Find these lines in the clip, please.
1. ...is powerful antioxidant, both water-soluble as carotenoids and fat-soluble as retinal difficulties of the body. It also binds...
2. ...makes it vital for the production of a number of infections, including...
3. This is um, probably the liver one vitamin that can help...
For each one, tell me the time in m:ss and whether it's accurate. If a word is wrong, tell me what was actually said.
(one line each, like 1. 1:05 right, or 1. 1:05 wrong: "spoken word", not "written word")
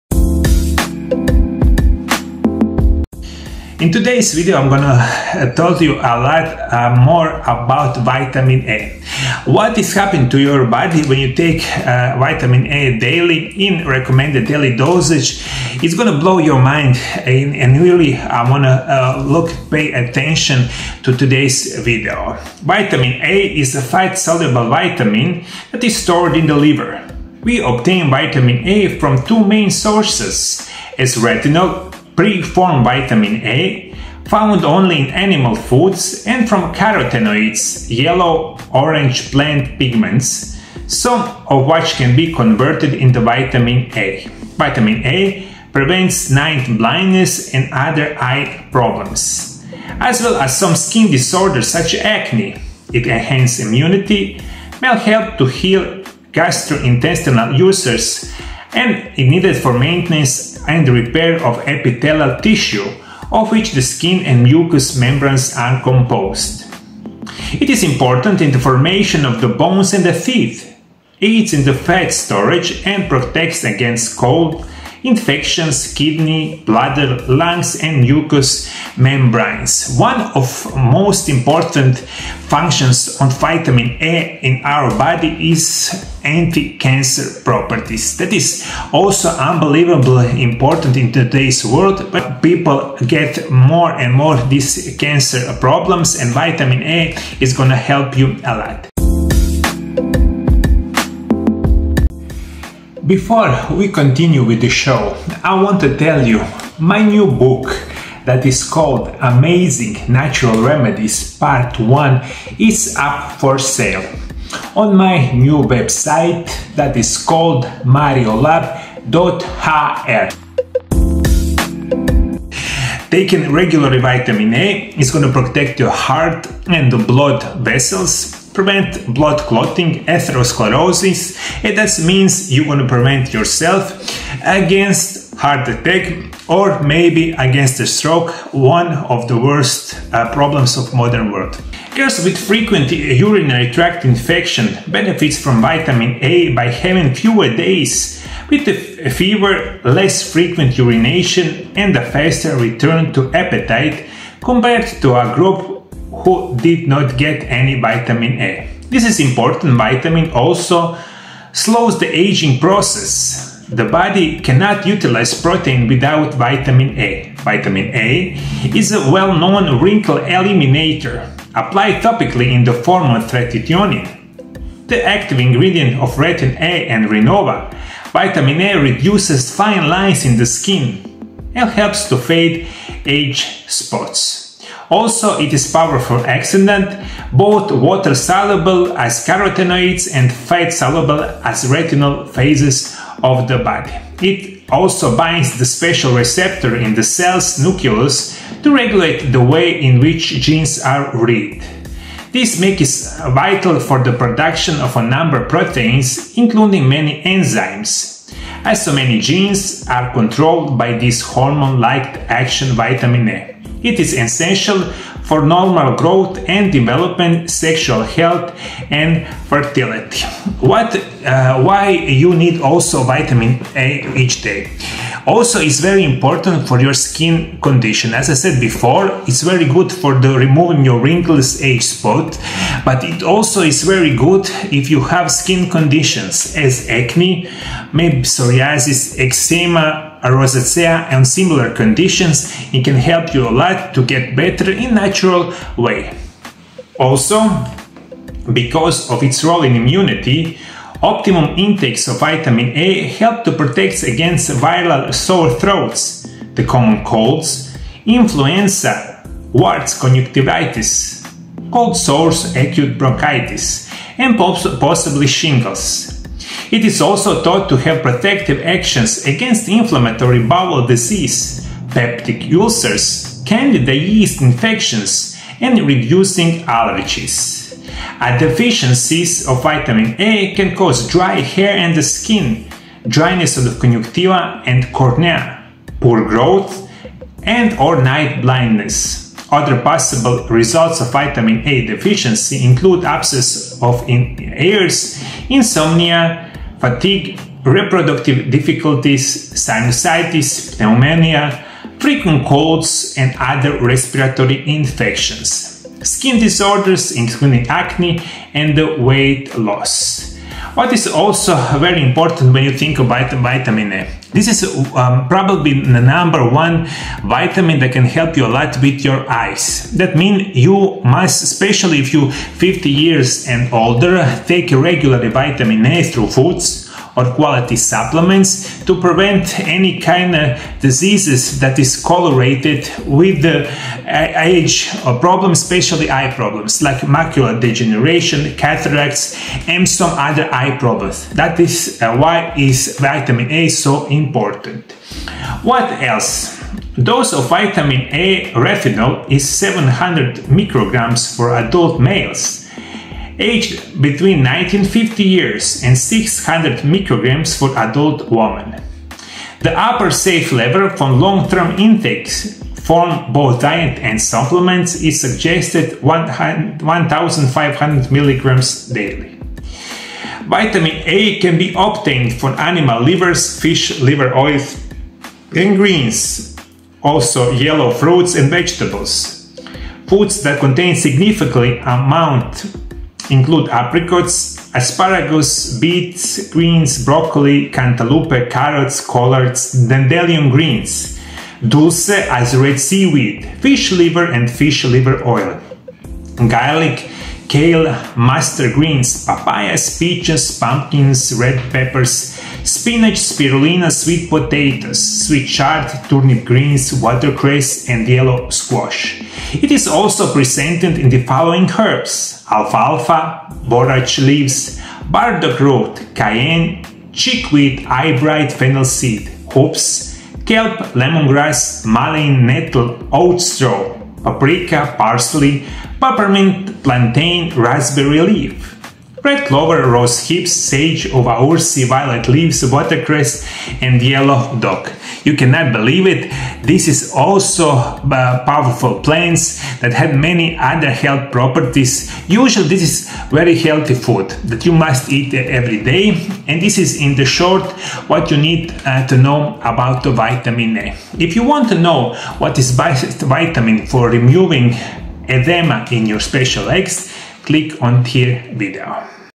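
1. 3:05 wrong: "phases", not "difficulties"
2. 3:22 wrong: "proteins", not "infections"
3. 5:14 wrong: "number", not "liver".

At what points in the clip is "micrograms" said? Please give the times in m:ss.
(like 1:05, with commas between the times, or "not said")
5:50, 5:56.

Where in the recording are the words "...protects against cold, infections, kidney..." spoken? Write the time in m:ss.
1:13.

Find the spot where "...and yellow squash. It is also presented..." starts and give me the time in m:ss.
6:47.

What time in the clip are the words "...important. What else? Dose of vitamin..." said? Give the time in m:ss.
5:44.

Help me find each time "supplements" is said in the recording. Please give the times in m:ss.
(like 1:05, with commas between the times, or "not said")
5:27, 6:04.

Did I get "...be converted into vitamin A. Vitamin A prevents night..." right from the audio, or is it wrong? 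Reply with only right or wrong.
right.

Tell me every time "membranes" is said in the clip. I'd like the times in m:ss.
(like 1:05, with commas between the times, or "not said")
1:04, 1:18.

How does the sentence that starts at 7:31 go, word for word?
If you want to know what is vitamin for removing edema in your special eggs, click on tier video.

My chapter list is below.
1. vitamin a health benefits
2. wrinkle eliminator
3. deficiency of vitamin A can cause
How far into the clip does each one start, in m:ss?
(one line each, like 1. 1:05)
1. 0:45
2. 2:41
3. 4:43.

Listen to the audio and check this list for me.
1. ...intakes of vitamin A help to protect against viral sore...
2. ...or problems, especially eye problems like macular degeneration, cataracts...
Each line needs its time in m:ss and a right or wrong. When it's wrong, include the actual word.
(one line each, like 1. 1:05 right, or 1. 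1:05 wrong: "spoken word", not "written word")
1. 4:11 right
2. 5:35 right.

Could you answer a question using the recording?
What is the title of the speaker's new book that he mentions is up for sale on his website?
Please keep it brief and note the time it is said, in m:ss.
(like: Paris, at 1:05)
Amazing Natural Remedies Part 1, at 1:49.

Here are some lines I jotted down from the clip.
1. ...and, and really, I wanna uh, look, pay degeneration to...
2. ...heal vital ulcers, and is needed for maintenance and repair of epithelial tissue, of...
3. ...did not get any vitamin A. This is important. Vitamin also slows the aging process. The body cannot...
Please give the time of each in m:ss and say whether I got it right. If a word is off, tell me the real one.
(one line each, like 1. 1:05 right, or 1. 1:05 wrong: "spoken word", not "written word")
1. 0:17 wrong: "attention", not "degeneration"
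2. 0:55 wrong: "gastrointestinal", not "vital"
3. 2:36 right.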